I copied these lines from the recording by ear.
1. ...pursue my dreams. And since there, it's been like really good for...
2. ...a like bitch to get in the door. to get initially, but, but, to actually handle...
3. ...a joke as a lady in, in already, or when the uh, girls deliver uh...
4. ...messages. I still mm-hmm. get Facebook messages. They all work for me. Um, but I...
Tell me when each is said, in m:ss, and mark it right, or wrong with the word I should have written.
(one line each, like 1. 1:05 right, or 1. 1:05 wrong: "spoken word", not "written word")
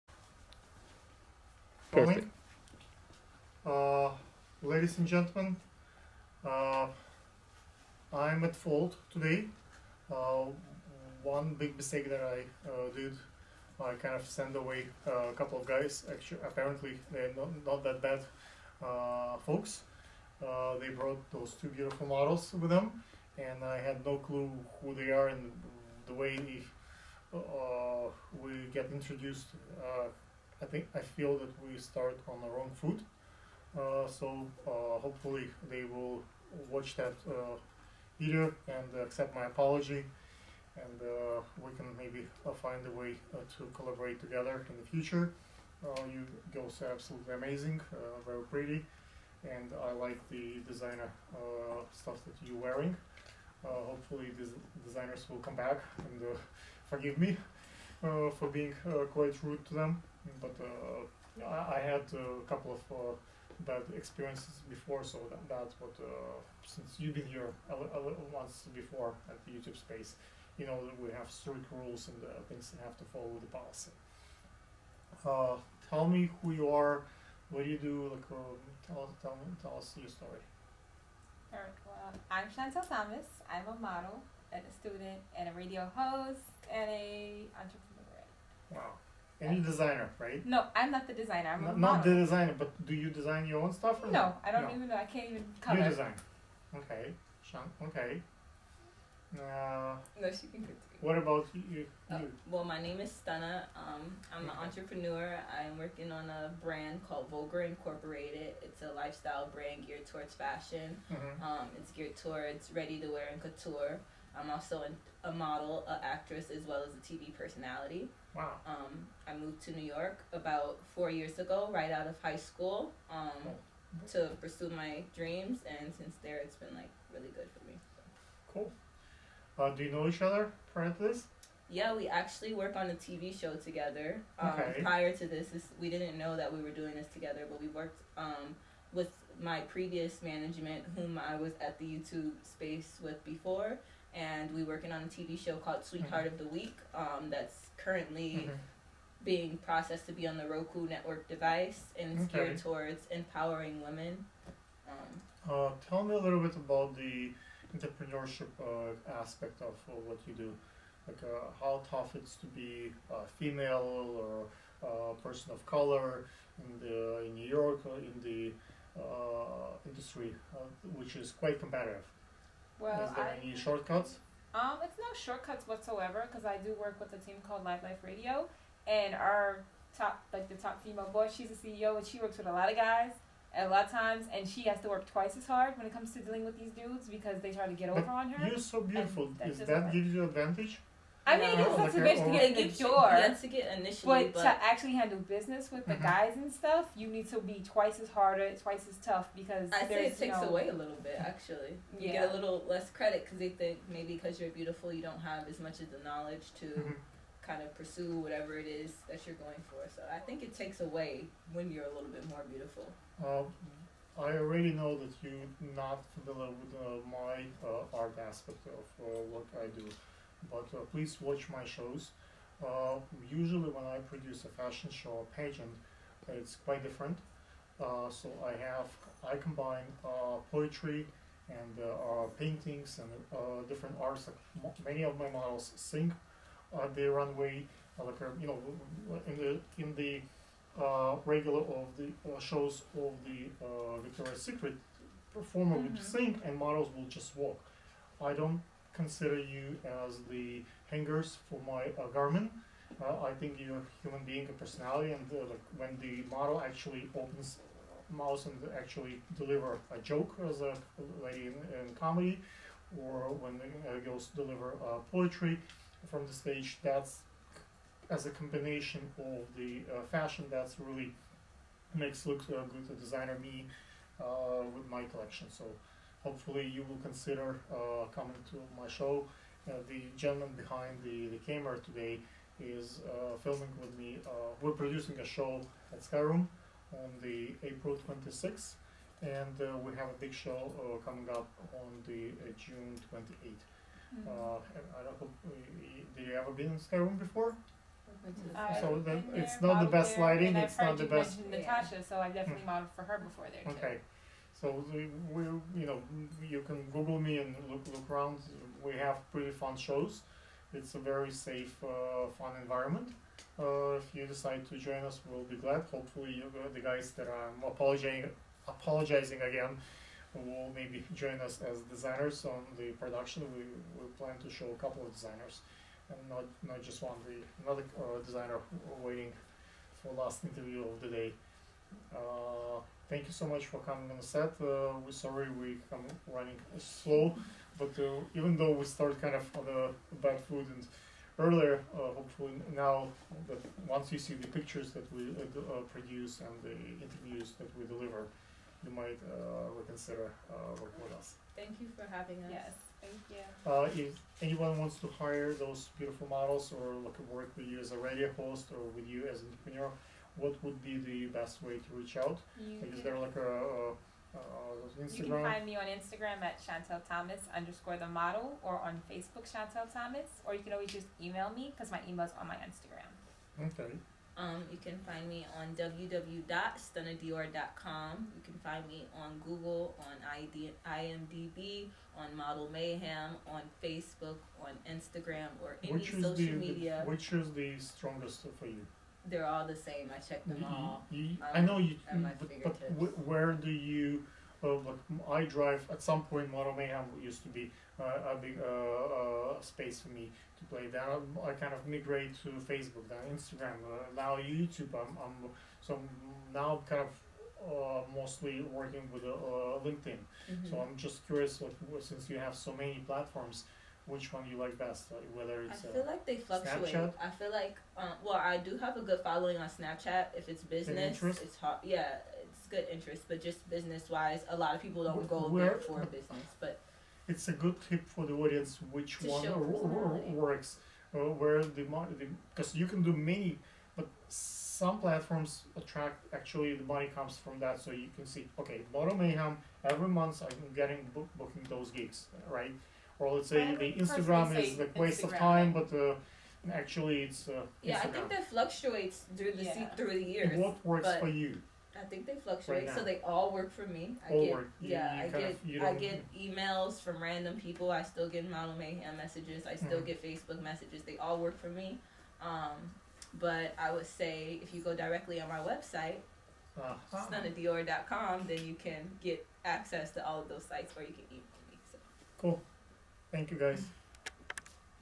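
1. 2:04 right
2. 3:11 right
3. 4:19 wrong: "comedy", not "already"
4. 7:39 right.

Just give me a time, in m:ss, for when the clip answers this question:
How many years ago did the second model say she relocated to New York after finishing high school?
2:00.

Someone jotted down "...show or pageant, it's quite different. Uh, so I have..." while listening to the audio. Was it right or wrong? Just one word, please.
right.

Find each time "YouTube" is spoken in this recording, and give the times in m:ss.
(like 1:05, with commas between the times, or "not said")
1:09, 2:21, 6:44.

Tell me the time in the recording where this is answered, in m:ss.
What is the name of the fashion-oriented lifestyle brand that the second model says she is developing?
1:47.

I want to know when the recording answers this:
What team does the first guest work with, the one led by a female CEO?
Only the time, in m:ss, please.
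2:57.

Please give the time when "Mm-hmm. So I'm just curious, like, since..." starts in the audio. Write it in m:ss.
6:50.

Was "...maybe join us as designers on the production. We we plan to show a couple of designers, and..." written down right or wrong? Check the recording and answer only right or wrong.
right.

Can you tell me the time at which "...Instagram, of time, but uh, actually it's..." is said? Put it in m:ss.
7:25.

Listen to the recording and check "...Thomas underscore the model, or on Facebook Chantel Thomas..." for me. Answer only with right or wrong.
right.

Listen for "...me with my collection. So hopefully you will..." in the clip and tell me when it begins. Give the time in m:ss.
4:33.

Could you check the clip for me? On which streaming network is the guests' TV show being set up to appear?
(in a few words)
Roku.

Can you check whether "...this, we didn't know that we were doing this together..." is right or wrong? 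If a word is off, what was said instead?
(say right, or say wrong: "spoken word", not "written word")
right.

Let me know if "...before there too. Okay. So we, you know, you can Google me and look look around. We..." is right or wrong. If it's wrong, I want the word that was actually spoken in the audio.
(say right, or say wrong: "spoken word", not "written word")
right.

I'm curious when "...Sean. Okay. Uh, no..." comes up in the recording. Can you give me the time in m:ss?
1:37.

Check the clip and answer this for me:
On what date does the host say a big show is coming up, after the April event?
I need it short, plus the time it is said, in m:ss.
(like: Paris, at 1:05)
June 28th, at 4:52.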